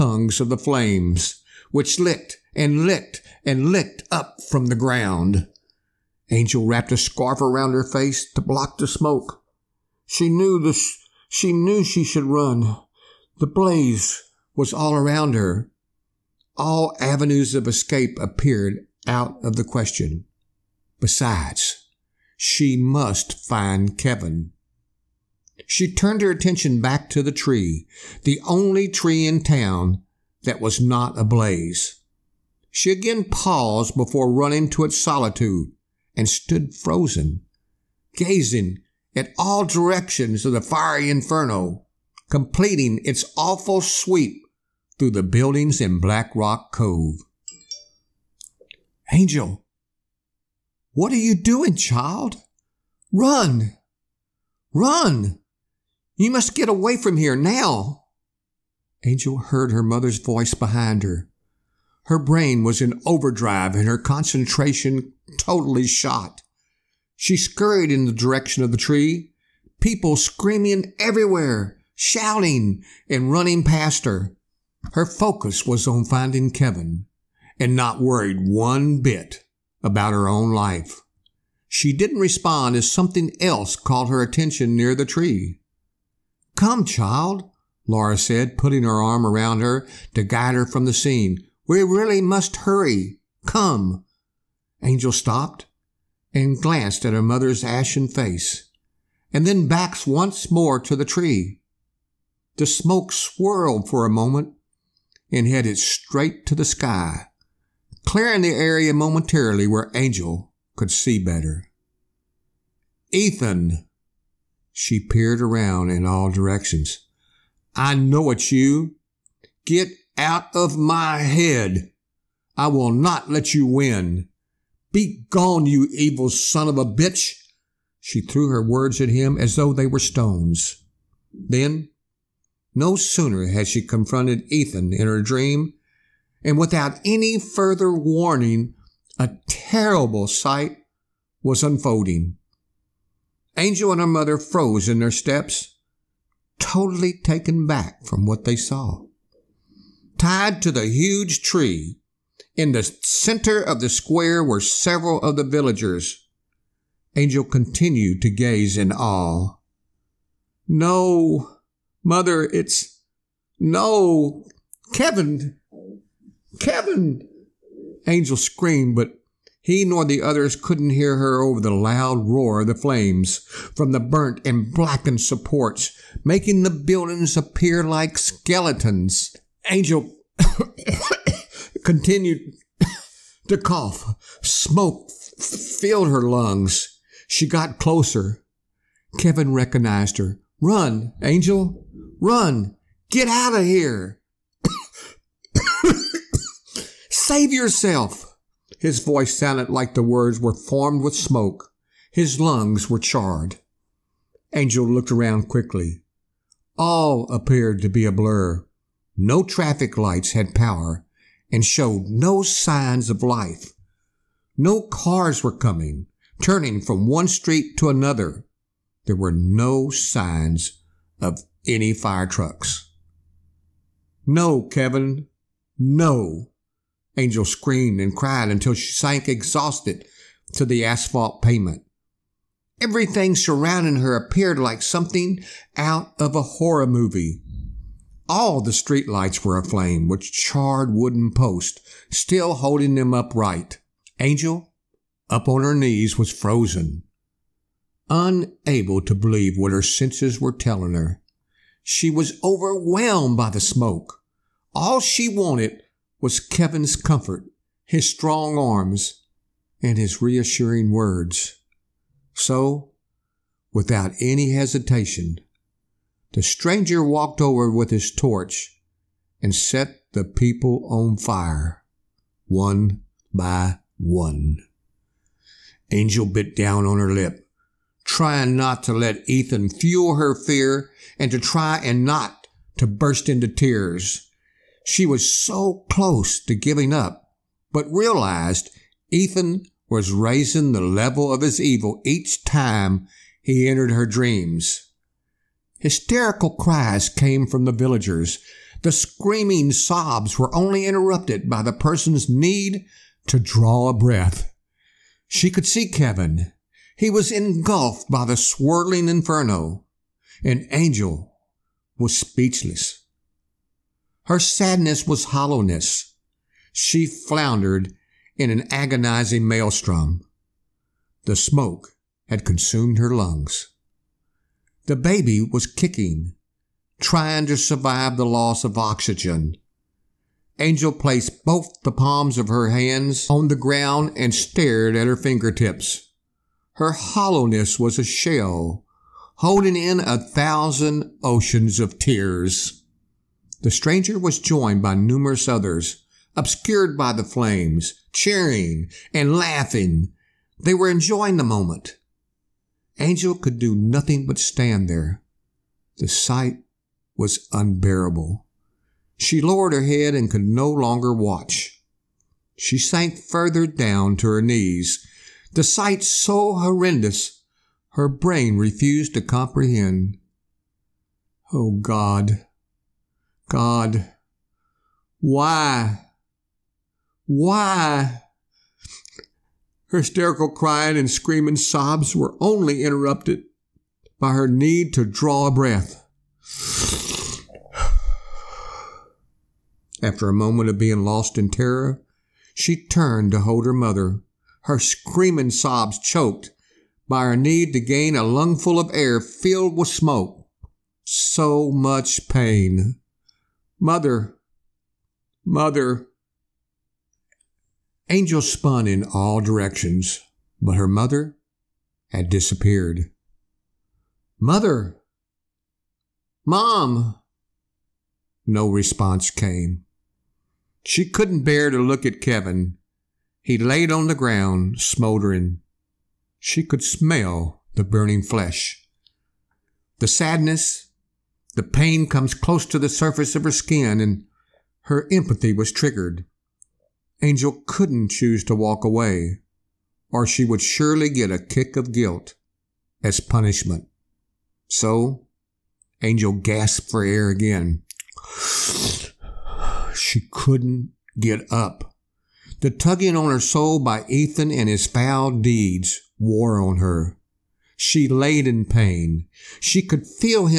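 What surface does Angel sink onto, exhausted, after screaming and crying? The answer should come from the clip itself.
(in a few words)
asphalt pavement.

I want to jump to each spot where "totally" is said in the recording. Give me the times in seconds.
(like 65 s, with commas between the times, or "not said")
65 s, 146 s.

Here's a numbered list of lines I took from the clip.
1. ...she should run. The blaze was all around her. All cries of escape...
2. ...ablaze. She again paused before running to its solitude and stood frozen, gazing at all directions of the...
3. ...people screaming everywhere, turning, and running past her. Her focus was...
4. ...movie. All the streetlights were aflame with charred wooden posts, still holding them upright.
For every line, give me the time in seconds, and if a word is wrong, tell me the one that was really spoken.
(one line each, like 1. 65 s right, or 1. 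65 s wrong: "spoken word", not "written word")
1. 11 s wrong: "avenues", not "cries"
2. 31 s right
3. 69 s wrong: "shouting", not "turning"
4. 236 s right.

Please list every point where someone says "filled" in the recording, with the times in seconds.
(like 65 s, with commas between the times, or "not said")
185 s, 399 s.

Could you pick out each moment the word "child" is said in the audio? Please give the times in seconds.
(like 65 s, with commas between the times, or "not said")
51 s, 86 s.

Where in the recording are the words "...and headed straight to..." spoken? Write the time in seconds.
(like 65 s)
105 s.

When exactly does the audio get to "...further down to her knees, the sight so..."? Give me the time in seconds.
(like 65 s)
363 s.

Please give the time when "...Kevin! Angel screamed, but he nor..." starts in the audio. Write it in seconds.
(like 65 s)
166 s.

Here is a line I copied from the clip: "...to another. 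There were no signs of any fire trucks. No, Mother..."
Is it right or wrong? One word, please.
wrong.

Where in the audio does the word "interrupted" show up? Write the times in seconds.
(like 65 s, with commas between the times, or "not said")
300 s, 382 s.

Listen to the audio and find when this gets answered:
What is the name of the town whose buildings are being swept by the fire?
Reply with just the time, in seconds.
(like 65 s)
45 s.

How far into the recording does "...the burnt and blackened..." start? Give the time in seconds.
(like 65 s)
173 s.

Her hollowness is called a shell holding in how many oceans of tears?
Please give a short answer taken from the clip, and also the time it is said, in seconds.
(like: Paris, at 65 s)
1000, at 339 s.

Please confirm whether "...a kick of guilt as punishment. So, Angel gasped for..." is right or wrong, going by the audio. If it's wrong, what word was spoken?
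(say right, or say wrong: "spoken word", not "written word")
right.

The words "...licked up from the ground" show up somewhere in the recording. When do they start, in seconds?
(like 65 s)
3 s.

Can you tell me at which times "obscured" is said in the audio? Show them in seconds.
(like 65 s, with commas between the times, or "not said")
346 s.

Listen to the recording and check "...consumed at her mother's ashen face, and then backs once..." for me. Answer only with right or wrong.
wrong.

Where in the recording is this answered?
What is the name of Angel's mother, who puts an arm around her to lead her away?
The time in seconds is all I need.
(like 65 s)
87 s.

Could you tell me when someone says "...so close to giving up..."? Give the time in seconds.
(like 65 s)
285 s.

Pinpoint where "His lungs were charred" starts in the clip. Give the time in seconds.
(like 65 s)
202 s.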